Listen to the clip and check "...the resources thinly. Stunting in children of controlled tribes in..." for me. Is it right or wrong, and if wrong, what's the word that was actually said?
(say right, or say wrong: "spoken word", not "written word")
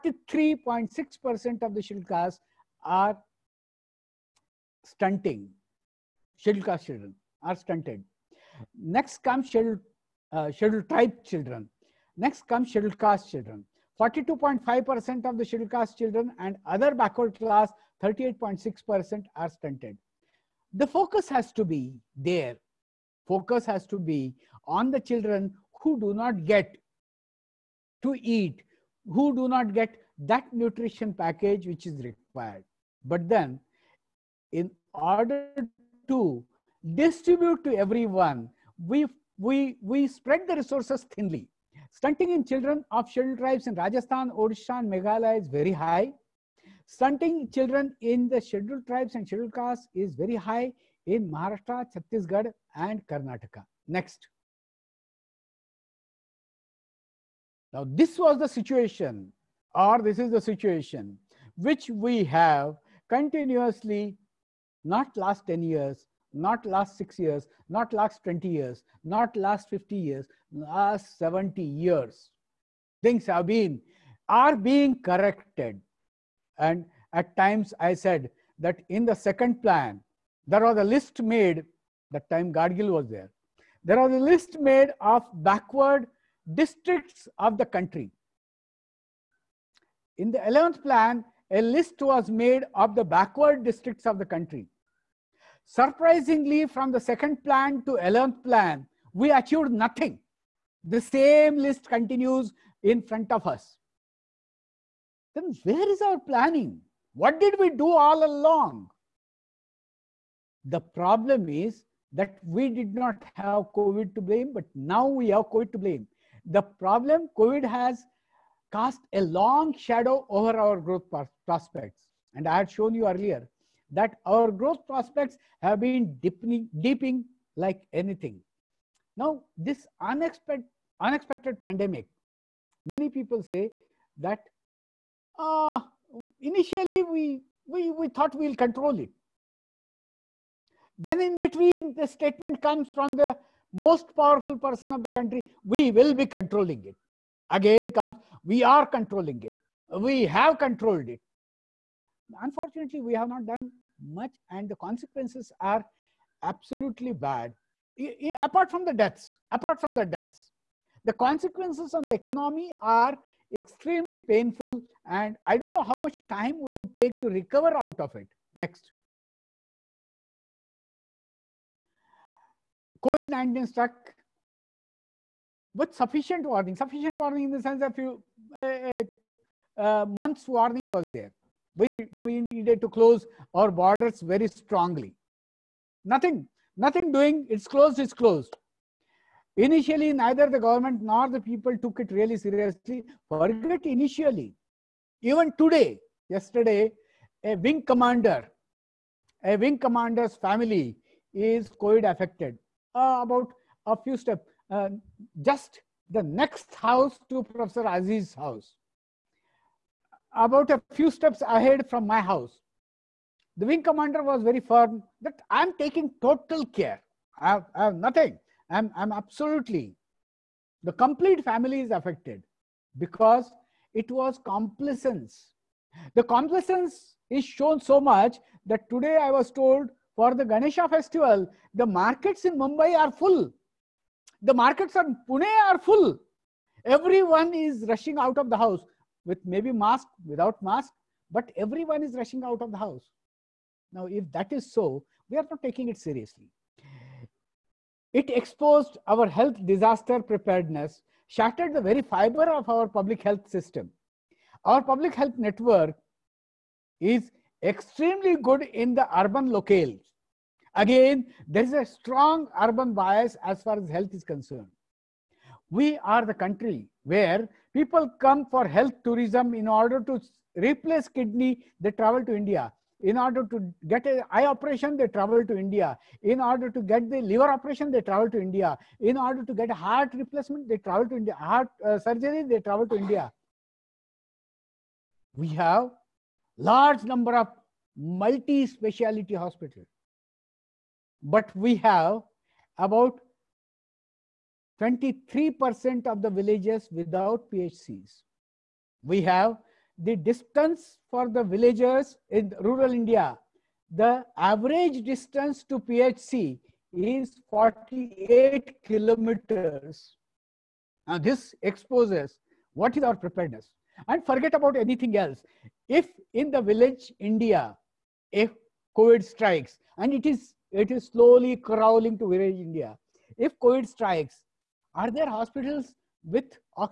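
wrong: "scheduled", not "controlled".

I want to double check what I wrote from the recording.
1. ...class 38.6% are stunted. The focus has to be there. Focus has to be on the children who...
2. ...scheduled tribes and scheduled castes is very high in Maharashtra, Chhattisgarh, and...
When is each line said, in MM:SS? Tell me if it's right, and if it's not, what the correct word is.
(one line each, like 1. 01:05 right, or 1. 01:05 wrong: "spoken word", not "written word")
1. 00:17 right
2. 00:48 right.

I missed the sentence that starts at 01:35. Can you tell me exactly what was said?
Surprisingly, from the second plan to 11th plan, we achieved nothing.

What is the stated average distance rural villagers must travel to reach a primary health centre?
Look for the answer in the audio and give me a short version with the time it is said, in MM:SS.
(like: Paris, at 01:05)
48 kilometers, at 05:07.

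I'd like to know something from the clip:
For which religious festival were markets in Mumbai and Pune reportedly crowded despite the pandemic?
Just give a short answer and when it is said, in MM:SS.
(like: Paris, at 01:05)
Ganesha festival, at 03:50.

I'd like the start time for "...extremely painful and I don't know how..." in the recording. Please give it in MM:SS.
02:43.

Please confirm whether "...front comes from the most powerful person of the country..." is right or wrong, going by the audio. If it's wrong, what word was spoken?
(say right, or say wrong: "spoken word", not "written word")
wrong: "statement", not "front".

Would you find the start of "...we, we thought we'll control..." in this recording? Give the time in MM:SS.
02:17.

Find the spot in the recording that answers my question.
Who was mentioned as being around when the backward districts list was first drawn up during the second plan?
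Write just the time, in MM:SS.
01:22.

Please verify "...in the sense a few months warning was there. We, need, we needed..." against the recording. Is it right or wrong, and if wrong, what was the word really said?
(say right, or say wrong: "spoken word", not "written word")
right.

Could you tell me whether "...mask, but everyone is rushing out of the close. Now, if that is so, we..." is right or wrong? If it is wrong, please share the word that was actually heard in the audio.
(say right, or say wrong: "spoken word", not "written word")
wrong: "house", not "close".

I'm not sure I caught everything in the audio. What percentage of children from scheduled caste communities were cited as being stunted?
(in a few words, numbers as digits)
42.5%.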